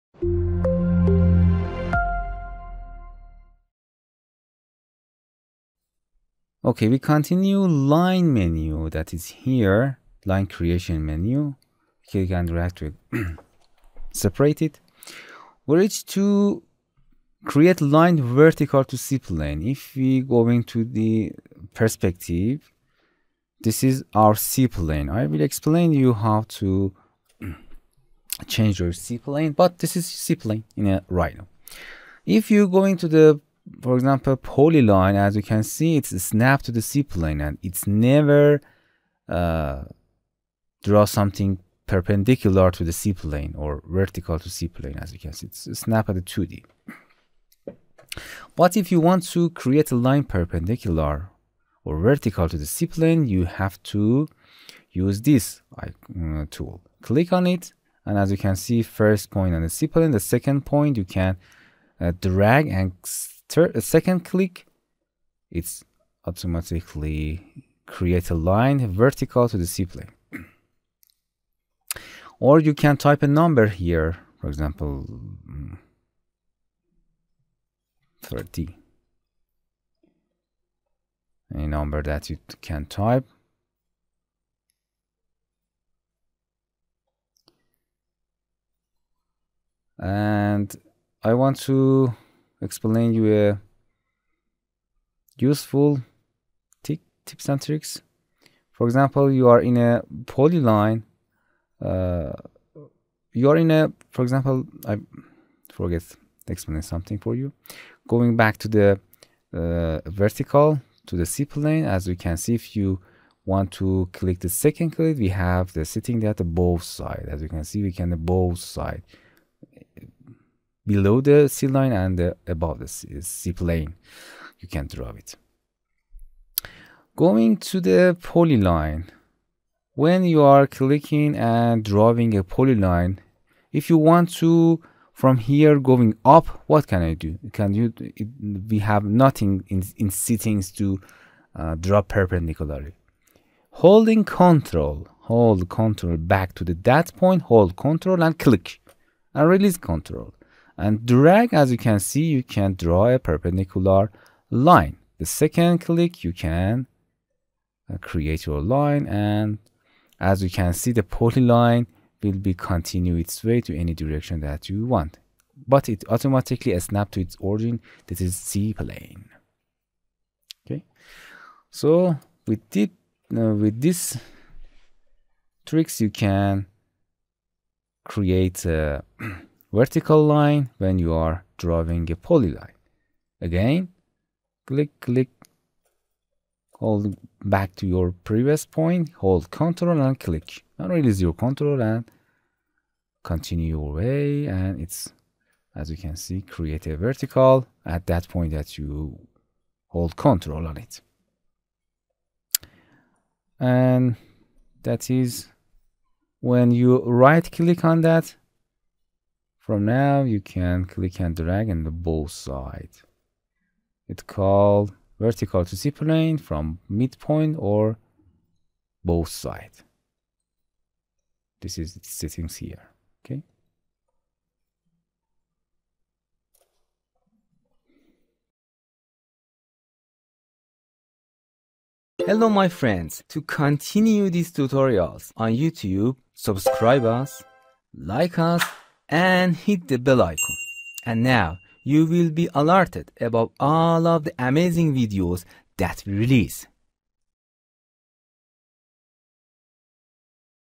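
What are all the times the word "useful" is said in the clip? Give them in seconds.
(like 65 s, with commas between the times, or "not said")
95 s.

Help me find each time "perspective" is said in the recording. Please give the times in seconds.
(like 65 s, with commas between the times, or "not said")
21 s.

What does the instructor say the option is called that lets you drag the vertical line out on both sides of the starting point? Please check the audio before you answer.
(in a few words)
from midpoint.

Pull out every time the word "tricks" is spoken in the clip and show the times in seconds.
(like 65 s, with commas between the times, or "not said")
97 s, 175 s.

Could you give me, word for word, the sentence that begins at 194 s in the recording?
And it's, as you can see, create a vertical at that point that you hold control on it.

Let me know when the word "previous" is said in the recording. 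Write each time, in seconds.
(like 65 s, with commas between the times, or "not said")
188 s.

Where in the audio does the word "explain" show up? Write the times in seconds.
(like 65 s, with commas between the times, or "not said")
25 s, 92 s, 106 s.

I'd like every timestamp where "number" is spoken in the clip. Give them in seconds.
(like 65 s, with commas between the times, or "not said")
73 s, 81 s.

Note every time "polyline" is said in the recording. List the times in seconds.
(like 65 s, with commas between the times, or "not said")
34 s, 100 s, 128 s, 132 s, 161 s, 182 s.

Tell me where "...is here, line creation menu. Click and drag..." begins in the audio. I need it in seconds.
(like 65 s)
9 s.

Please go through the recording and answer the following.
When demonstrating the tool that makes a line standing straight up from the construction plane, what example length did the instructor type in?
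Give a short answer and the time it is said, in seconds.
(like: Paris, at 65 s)
30, at 78 s.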